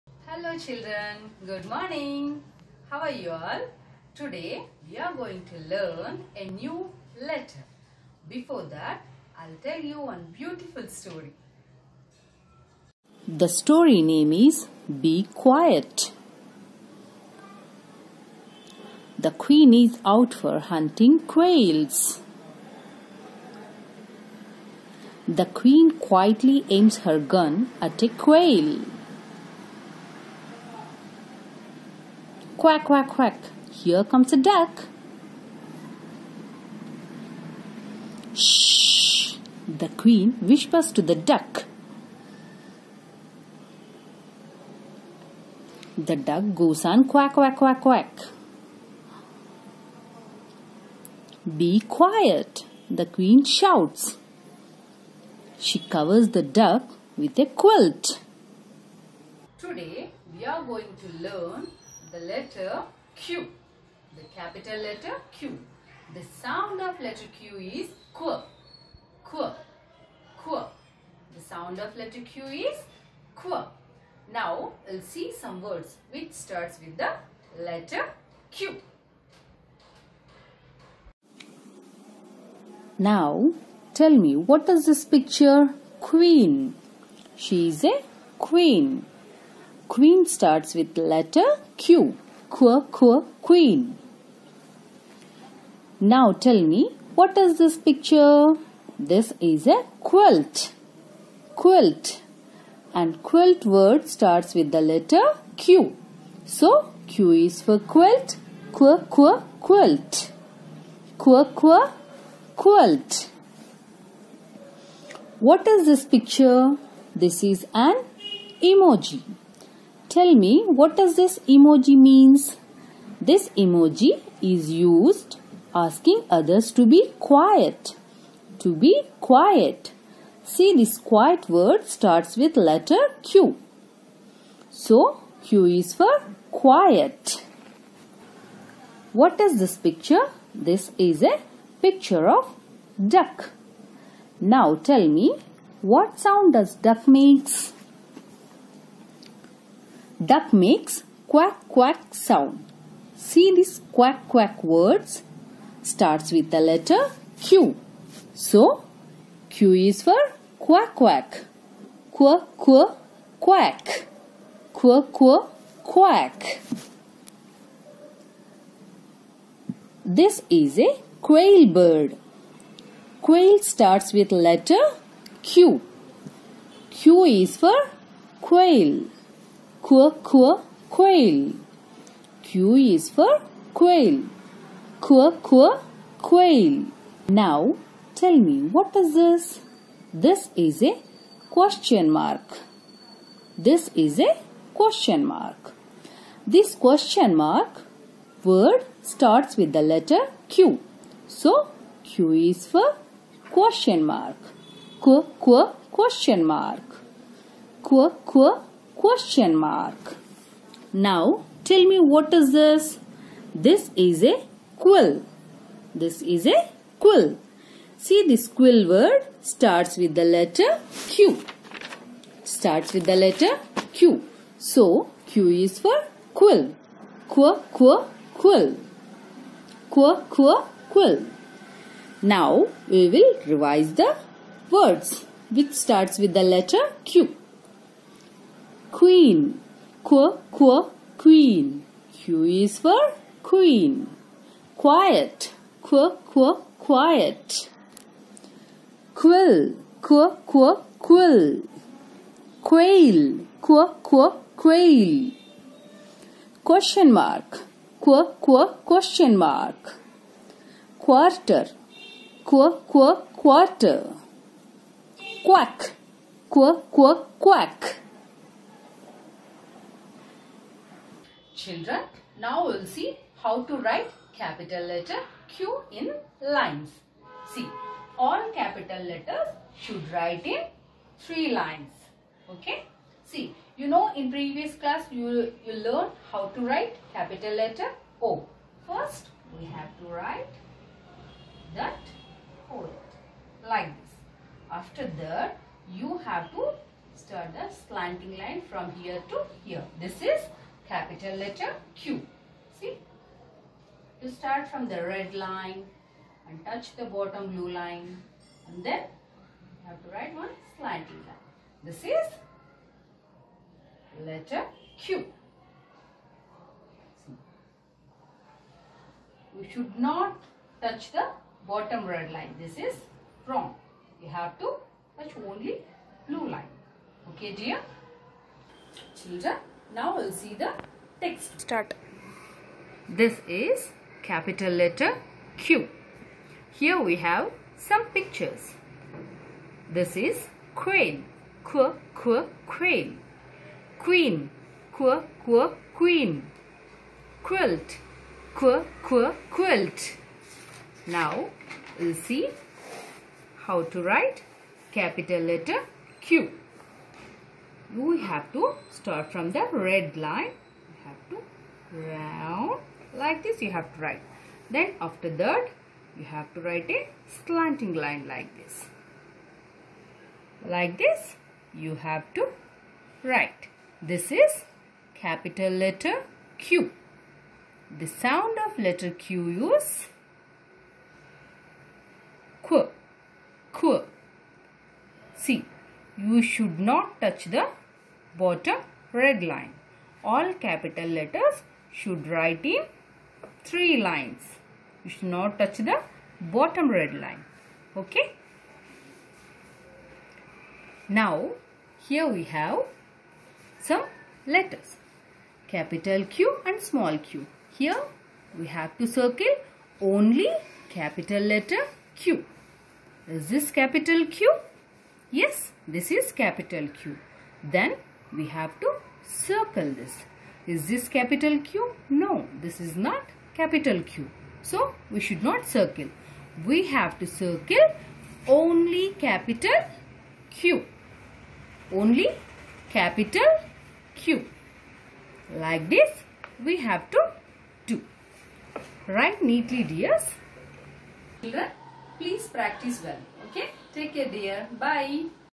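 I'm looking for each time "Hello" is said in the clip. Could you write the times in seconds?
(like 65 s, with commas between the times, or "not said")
0 s.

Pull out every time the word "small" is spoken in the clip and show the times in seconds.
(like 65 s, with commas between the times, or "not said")
406 s.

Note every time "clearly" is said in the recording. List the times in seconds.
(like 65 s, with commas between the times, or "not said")
not said.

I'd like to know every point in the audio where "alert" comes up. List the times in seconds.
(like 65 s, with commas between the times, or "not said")
not said.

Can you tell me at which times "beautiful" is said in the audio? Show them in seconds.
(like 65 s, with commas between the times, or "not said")
10 s.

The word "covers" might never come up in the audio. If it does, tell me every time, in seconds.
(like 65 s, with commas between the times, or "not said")
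55 s.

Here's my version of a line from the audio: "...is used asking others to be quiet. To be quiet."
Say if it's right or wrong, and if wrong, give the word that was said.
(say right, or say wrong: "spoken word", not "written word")
right.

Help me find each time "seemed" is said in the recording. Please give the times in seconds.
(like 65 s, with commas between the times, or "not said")
not said.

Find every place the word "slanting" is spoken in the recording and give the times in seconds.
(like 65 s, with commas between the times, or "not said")
297 s, 310 s, 367 s.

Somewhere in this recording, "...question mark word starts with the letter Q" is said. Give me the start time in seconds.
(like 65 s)
196 s.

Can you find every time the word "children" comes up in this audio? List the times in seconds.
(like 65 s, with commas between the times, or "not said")
0 s, 271 s, 329 s.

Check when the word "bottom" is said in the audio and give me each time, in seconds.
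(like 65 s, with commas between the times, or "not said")
307 s, 321 s, 388 s, 396 s.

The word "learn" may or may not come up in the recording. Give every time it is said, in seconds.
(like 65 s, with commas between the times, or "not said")
5 s, 61 s, 285 s.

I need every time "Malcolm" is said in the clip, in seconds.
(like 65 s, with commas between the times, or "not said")
not said.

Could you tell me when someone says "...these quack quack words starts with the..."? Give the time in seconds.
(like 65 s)
153 s.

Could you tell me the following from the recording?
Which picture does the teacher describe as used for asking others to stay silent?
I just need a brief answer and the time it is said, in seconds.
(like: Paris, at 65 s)
An emoji, at 117 s.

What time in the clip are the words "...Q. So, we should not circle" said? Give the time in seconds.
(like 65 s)
424 s.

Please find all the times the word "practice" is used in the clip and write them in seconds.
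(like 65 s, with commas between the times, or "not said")
442 s.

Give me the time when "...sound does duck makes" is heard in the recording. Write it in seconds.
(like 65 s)
146 s.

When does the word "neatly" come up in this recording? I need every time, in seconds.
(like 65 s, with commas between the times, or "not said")
439 s.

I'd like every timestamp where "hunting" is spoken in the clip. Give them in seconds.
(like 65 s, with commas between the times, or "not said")
20 s.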